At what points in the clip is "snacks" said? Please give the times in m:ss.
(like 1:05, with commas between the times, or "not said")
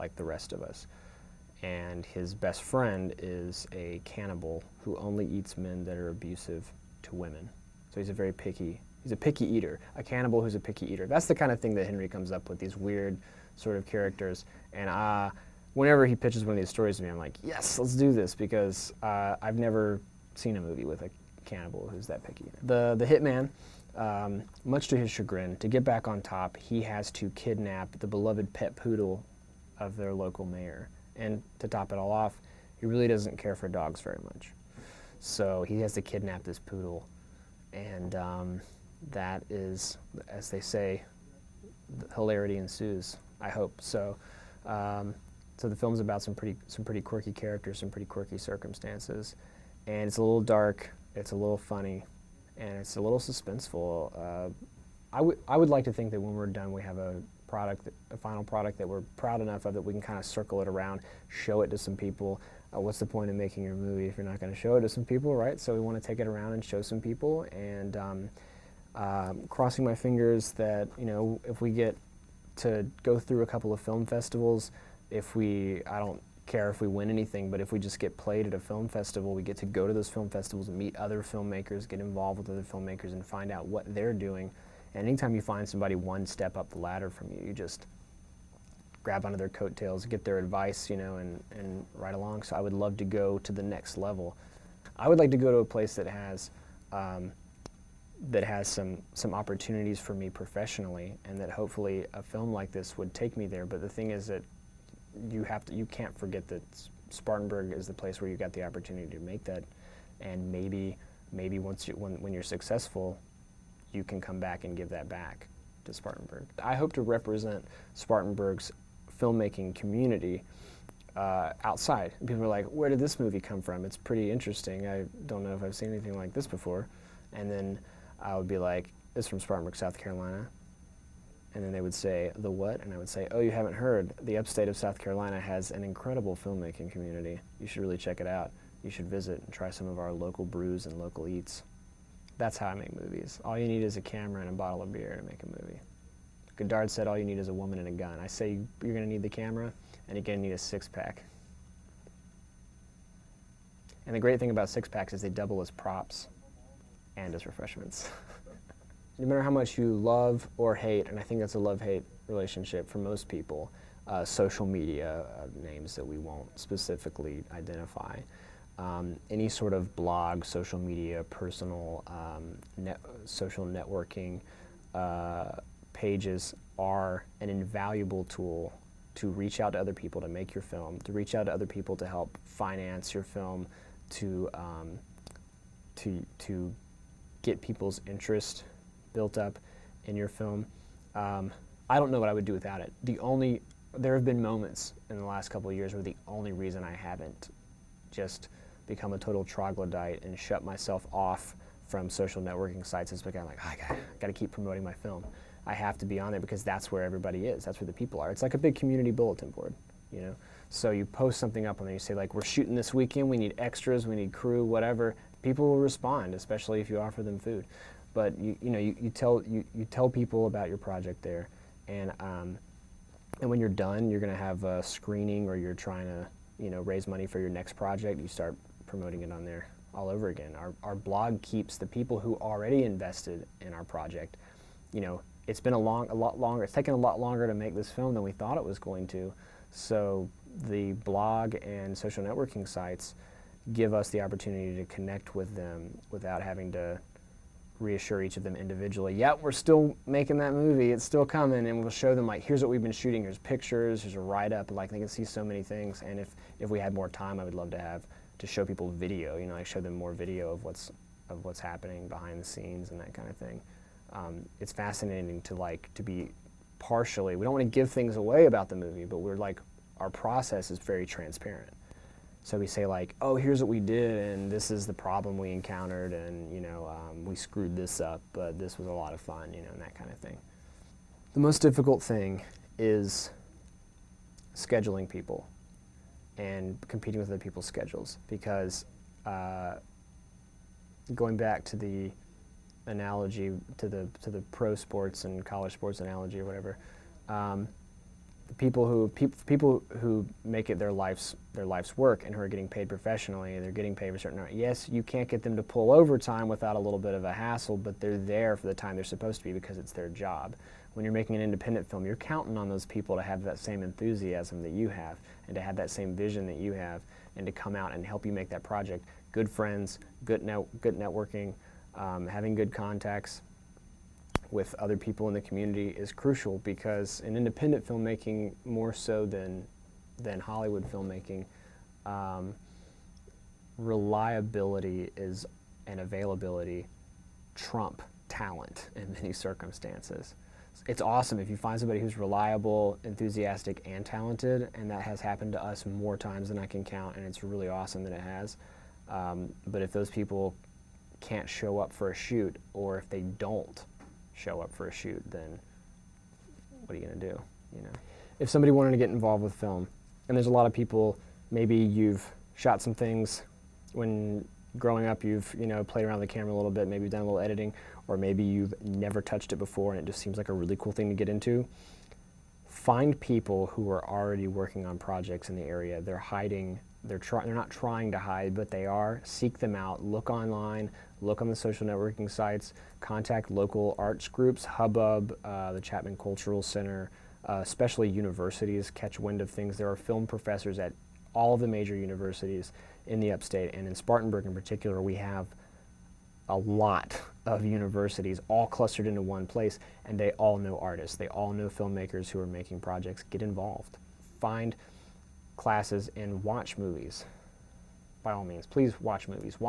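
not said.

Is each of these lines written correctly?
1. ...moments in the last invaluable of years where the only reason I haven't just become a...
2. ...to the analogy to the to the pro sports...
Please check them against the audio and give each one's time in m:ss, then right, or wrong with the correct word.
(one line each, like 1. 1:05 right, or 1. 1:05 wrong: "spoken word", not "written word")
1. 3:14 wrong: "couple", not "invaluable"
2. 4:51 right.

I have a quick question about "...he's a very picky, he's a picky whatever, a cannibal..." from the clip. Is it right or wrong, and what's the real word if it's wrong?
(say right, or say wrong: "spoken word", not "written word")
wrong: "eater", not "whatever".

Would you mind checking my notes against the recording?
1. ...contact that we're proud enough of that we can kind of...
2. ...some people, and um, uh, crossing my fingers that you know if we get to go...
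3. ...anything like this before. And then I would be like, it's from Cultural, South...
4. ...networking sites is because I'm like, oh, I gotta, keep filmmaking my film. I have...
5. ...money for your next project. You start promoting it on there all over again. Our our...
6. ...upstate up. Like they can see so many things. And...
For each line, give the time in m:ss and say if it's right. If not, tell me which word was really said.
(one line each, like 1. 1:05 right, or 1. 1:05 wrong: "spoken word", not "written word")
1. 0:58 wrong: "product", not "contact"
2. 1:06 right
3. 2:05 wrong: "Spartanburg", not "Cultural"
4. 3:22 wrong: "promoting", not "filmmaking"
5. 3:47 right
6. 4:14 wrong: "write", not "upstate".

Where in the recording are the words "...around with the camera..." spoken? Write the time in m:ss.
6:06.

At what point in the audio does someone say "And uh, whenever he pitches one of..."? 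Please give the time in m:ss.
0:14.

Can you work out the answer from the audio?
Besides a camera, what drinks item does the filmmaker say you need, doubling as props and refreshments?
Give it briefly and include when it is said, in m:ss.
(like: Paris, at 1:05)
A six-pack, at 2:30.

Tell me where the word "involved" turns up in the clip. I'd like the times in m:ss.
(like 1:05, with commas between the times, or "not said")
1:22, 5:59, 6:43.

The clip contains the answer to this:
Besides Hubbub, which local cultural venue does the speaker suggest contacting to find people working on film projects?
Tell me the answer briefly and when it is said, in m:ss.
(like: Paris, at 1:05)
The Chapman Cultural Center, at 6:25.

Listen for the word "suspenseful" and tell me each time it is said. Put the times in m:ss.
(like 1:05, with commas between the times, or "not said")
0:53.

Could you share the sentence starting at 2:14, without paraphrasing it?
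The upstate of South Carolina has an incredible filmmaking community.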